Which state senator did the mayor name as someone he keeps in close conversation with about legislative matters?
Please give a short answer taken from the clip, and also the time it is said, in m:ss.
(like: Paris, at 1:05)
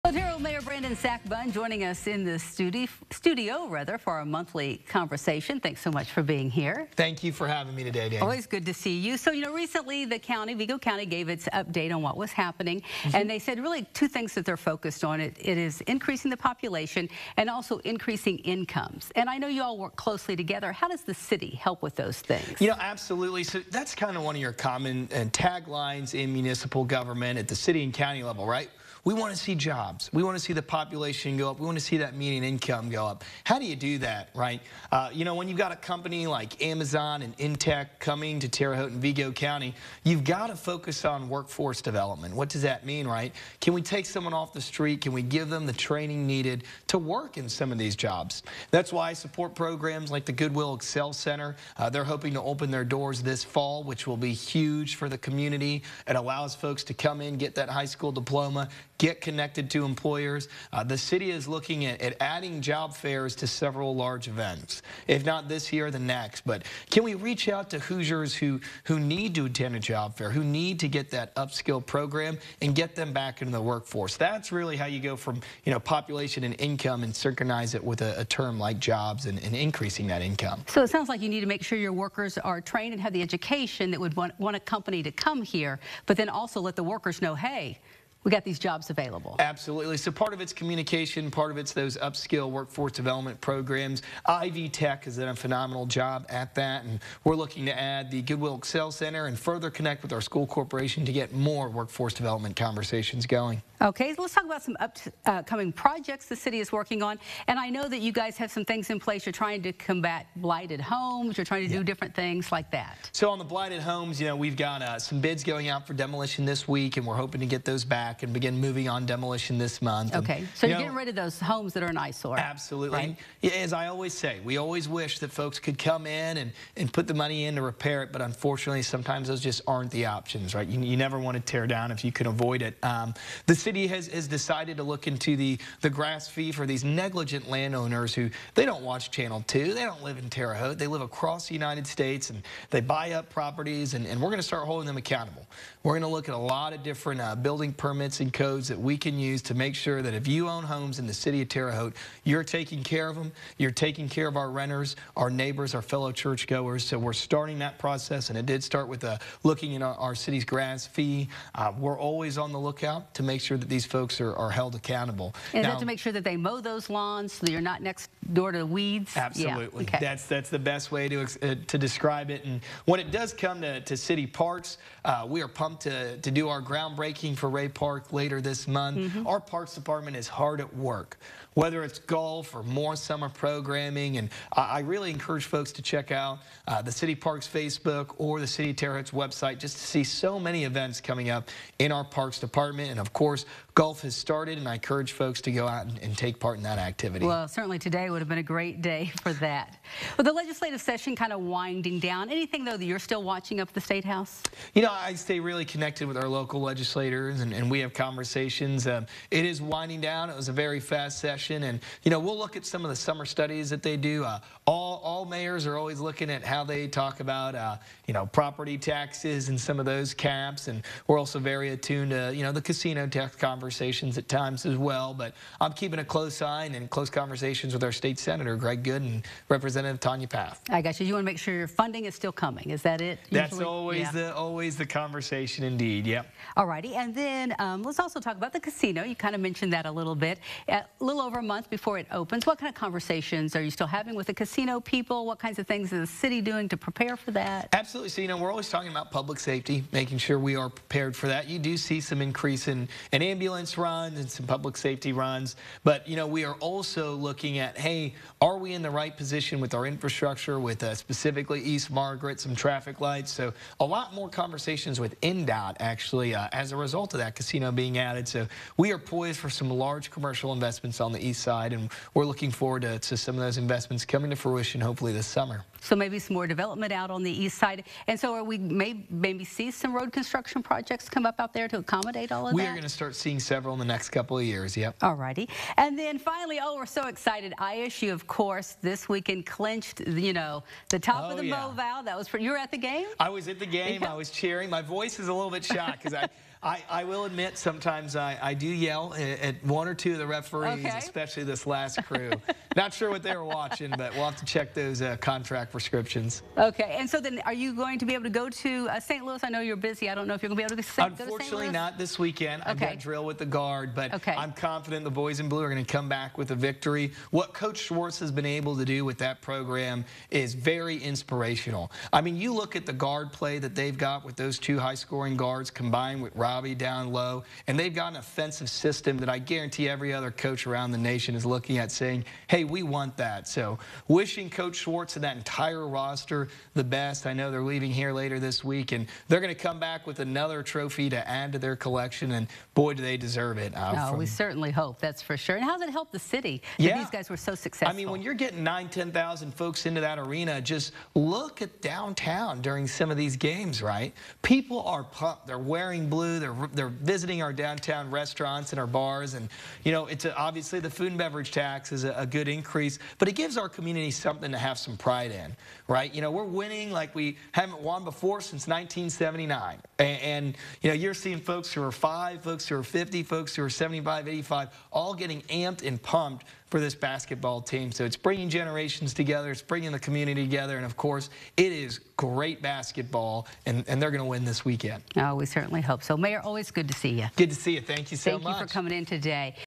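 Greg Goode, at 3:48.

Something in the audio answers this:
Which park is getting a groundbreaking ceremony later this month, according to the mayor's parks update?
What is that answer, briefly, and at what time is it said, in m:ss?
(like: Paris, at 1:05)
Rea Park, at 2:57.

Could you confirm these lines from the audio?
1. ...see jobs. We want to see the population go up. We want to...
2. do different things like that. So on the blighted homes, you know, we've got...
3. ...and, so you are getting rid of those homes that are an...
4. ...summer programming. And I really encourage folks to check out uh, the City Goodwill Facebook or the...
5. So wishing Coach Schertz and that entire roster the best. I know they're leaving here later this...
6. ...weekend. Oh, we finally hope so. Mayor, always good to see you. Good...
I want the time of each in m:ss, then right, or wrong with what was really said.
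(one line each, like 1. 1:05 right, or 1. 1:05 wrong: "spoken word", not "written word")
1. 0:29 right
2. 1:51 right
3. 2:00 right
4. 3:02 wrong: "Parks", not "Goodwill"
5. 5:33 right
6. 6:24 wrong: "certainly", not "finally".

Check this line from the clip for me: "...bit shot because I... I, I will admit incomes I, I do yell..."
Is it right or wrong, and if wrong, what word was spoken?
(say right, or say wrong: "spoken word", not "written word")
wrong: "sometimes", not "incomes".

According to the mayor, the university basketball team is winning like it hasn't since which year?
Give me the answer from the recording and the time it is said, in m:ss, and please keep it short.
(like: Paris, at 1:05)
1979, at 6:08.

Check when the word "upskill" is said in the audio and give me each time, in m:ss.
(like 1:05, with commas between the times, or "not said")
1:11, 1:31.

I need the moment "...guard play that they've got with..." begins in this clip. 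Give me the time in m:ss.
5:22.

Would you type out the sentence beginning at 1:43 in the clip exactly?
Okay, let's talk about some upcoming projects the city is working on.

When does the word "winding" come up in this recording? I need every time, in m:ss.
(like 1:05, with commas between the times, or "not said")
3:21, 3:29.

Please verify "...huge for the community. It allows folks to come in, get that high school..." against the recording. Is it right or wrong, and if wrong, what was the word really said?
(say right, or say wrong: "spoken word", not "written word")
right.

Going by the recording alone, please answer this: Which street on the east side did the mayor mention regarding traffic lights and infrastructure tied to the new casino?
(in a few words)
East Margaret.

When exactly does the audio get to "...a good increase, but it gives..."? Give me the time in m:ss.
6:02.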